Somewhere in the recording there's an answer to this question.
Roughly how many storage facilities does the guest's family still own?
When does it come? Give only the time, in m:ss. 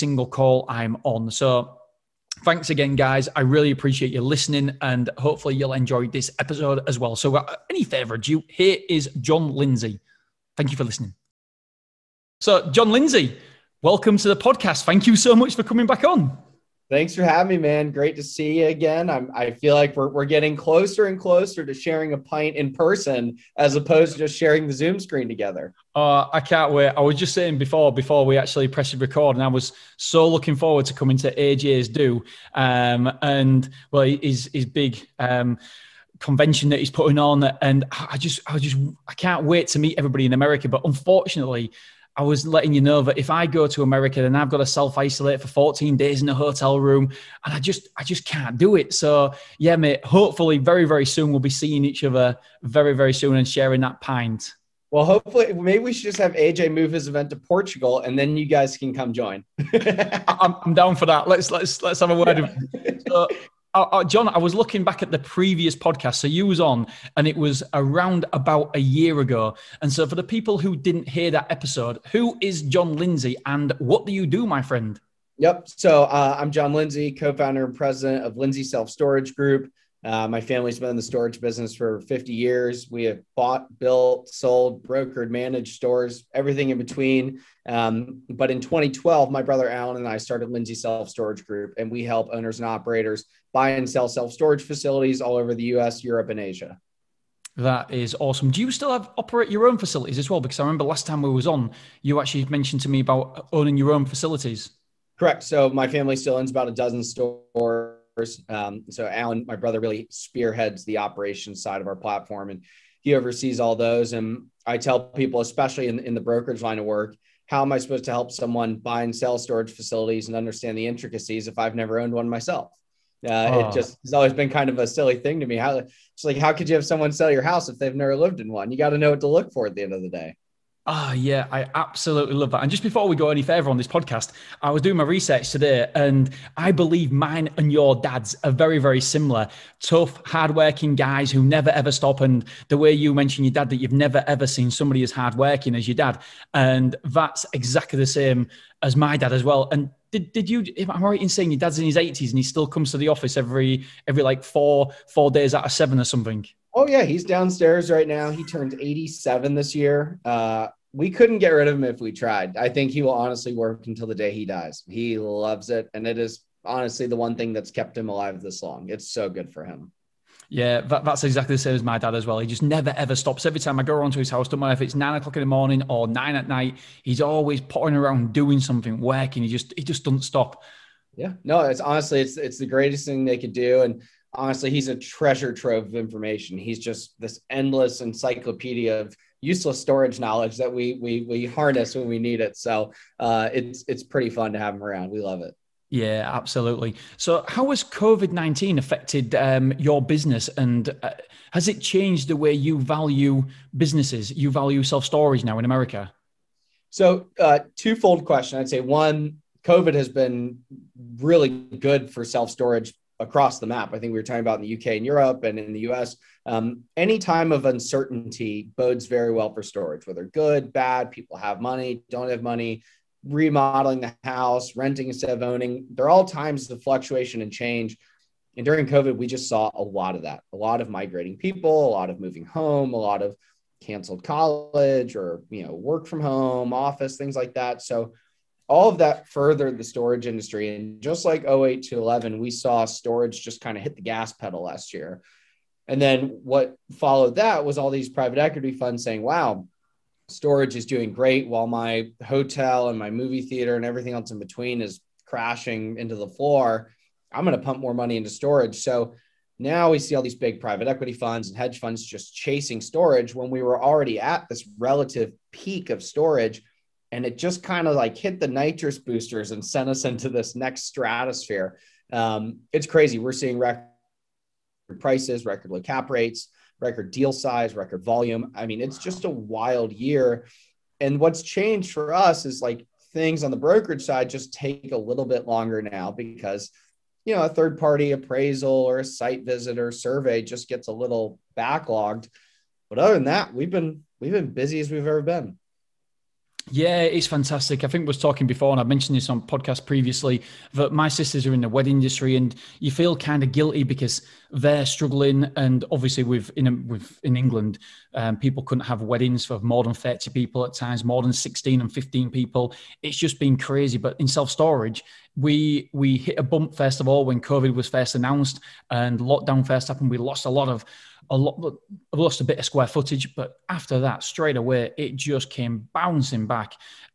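1:46.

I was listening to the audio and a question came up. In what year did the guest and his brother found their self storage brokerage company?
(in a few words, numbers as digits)
2012.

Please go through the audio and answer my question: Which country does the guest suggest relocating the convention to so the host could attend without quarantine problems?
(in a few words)
Portugal.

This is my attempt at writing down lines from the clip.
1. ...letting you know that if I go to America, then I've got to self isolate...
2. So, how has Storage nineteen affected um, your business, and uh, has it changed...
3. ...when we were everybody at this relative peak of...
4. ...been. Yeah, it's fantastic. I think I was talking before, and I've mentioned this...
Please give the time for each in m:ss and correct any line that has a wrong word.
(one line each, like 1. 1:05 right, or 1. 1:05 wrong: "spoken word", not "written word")
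1. 0:42 right
2. 3:17 wrong: "COVID", not "Storage"
3. 4:23 wrong: "already", not "everybody"
4. 4:55 right.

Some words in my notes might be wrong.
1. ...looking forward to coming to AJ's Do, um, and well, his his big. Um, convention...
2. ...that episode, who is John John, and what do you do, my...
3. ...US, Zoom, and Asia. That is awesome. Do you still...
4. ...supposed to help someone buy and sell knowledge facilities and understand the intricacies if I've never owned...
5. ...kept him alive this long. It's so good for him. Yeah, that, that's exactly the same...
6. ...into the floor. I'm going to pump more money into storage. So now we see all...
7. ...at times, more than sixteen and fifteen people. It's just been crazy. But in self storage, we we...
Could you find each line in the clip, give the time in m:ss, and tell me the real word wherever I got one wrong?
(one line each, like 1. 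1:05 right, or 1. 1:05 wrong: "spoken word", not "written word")
1. 0:30 right
2. 1:11 wrong: "Lindsey", not "John"
3. 1:35 wrong: "Europe", not "Zoom"
4. 1:57 wrong: "storage", not "knowledge"
5. 2:47 right
6. 4:15 right
7. 5:10 right.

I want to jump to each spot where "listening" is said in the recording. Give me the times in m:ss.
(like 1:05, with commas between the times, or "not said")
0:04, 0:10.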